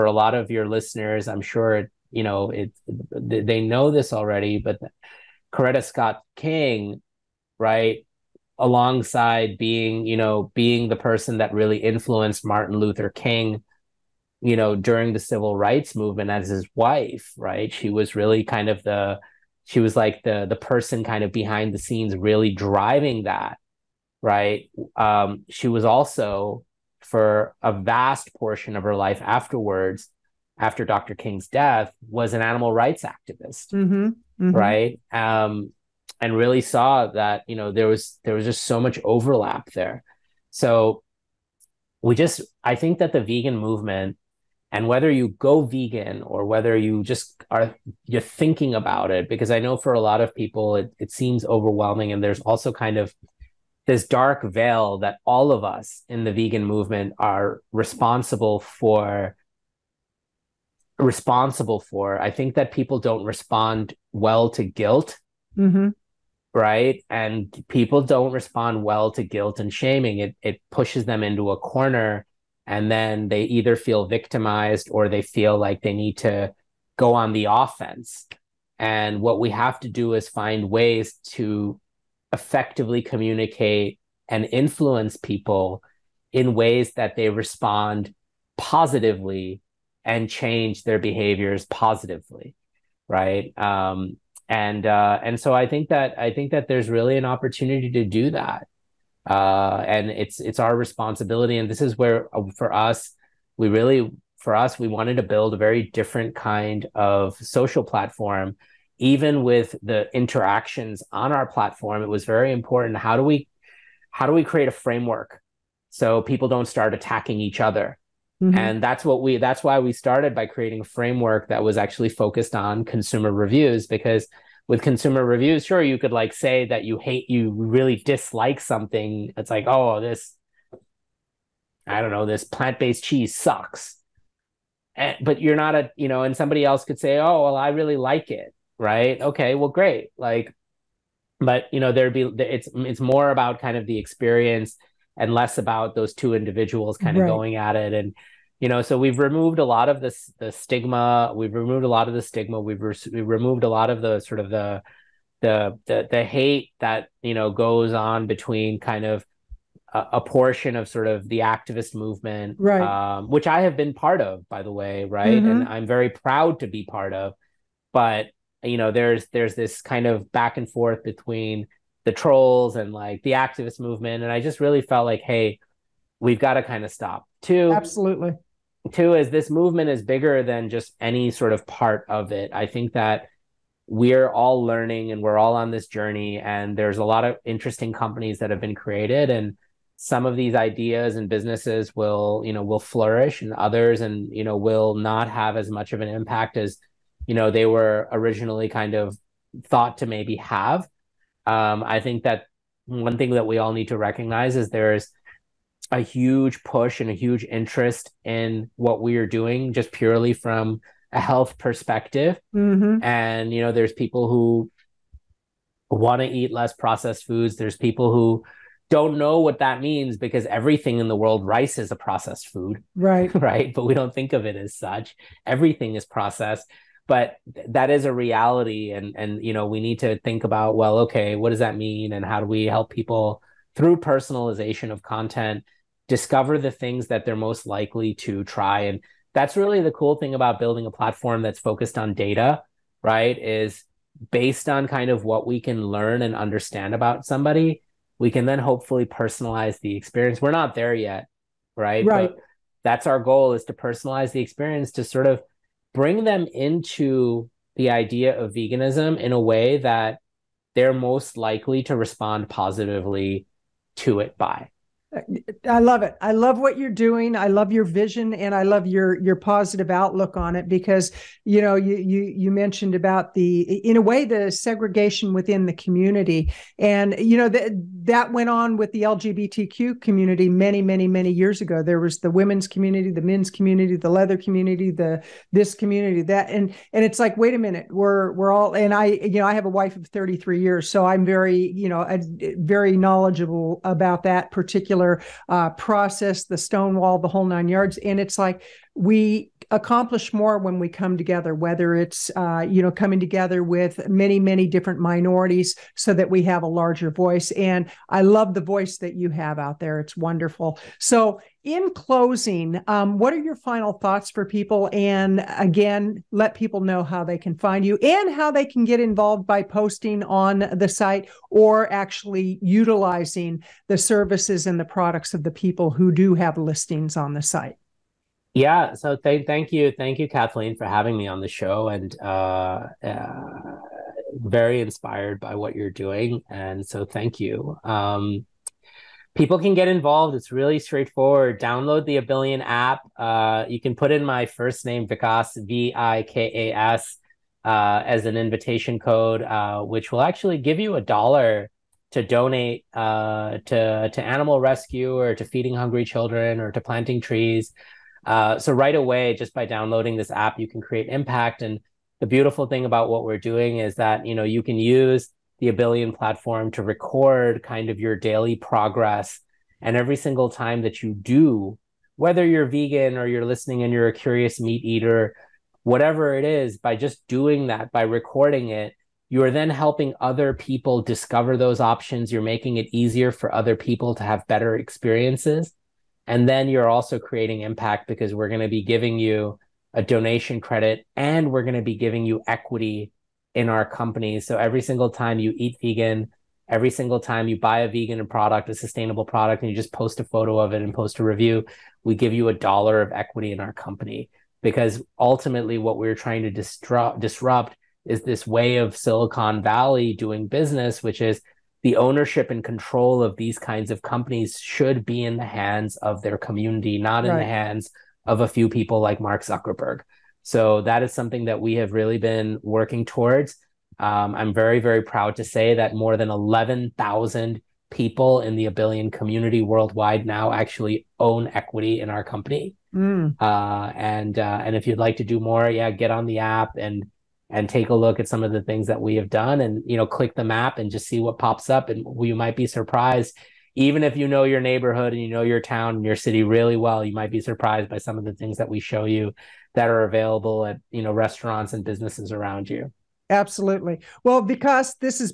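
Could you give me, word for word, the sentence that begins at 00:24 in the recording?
Um, she was also for a vast portion of her life afterwards, after Dr.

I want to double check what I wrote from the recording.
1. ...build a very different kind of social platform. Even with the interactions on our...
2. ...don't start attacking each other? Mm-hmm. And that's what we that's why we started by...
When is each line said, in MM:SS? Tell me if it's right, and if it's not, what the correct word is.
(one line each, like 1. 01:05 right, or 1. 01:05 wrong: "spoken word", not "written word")
1. 01:45 right
2. 01:56 right.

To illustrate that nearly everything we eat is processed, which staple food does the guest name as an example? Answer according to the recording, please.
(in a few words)
Rice.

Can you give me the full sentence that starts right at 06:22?
You're making it easier for other people to have better experiences.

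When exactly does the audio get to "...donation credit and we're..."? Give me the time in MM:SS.
06:30.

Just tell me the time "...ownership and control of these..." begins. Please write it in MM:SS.
06:51.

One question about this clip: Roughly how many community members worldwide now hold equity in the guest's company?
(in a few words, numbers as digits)
11,000.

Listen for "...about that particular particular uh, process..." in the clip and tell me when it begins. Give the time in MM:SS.
04:53.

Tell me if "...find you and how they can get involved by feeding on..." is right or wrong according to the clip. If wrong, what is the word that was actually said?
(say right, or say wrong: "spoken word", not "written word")
wrong: "posting", not "feeding".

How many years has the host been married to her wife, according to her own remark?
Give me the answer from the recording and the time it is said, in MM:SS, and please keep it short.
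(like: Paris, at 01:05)
33 years, at 04:50.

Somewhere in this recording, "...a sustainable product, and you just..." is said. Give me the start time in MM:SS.
06:38.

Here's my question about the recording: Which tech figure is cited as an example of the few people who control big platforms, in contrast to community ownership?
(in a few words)
Mark Zuckerberg.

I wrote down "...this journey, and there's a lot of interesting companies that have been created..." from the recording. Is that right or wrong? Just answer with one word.
right.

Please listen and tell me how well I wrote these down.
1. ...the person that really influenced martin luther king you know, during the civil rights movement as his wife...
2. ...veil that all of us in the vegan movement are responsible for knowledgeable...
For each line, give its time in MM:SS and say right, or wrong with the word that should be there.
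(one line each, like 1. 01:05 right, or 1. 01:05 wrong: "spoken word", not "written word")
1. 00:10 right
2. 00:54 wrong: "responsible", not "knowledgeable".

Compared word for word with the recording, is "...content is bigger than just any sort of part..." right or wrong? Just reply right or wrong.
wrong.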